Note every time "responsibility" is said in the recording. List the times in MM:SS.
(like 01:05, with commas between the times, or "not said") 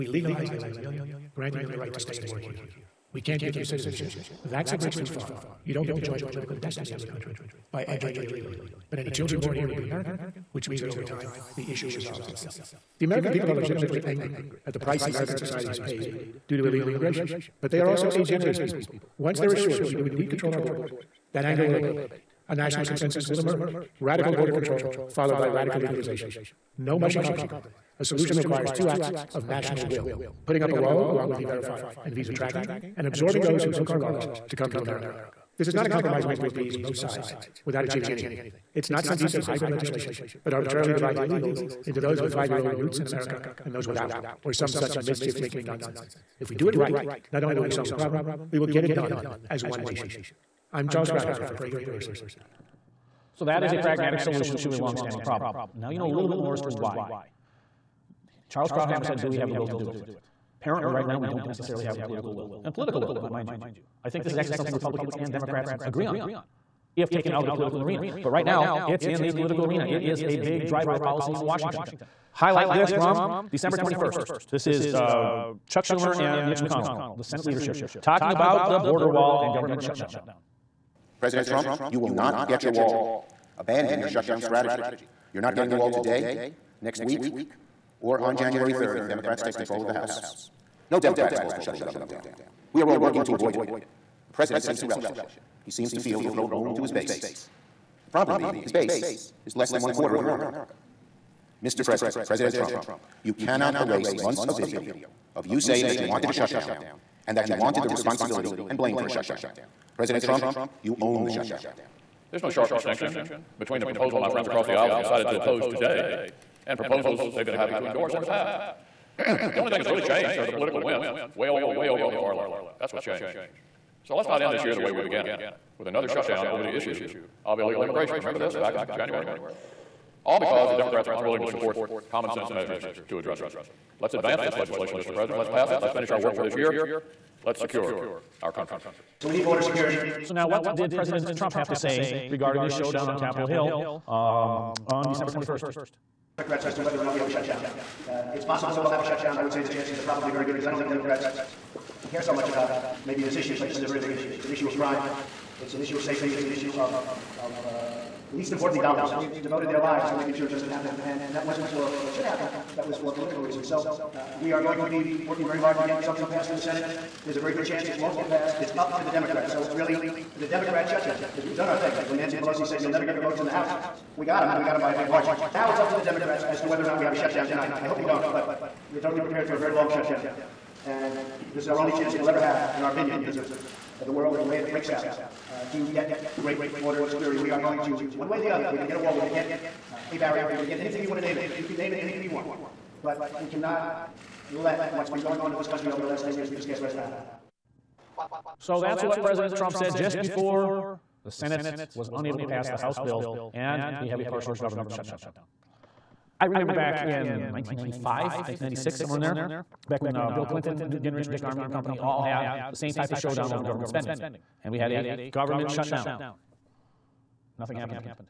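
01:47.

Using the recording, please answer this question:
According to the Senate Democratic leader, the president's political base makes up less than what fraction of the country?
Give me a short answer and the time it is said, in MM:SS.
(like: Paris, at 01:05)
one quarter, at 01:39.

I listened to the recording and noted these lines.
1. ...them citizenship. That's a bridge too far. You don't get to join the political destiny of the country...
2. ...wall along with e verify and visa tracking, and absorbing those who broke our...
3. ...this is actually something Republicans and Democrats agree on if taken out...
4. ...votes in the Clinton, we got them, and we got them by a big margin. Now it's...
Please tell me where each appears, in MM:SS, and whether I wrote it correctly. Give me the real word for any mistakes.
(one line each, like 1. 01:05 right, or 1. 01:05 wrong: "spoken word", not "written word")
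1. 00:03 right
2. 00:30 right
3. 01:04 right
4. 02:53 wrong: "House", not "Clinton".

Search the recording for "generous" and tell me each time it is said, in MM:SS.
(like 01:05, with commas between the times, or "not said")
00:18.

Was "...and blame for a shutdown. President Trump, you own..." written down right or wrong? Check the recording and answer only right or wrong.
right.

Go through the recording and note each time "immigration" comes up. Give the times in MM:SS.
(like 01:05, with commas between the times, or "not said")
00:16, 02:07.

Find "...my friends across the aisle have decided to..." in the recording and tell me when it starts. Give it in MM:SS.
01:54.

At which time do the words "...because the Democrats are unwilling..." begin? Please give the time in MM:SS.
02:10.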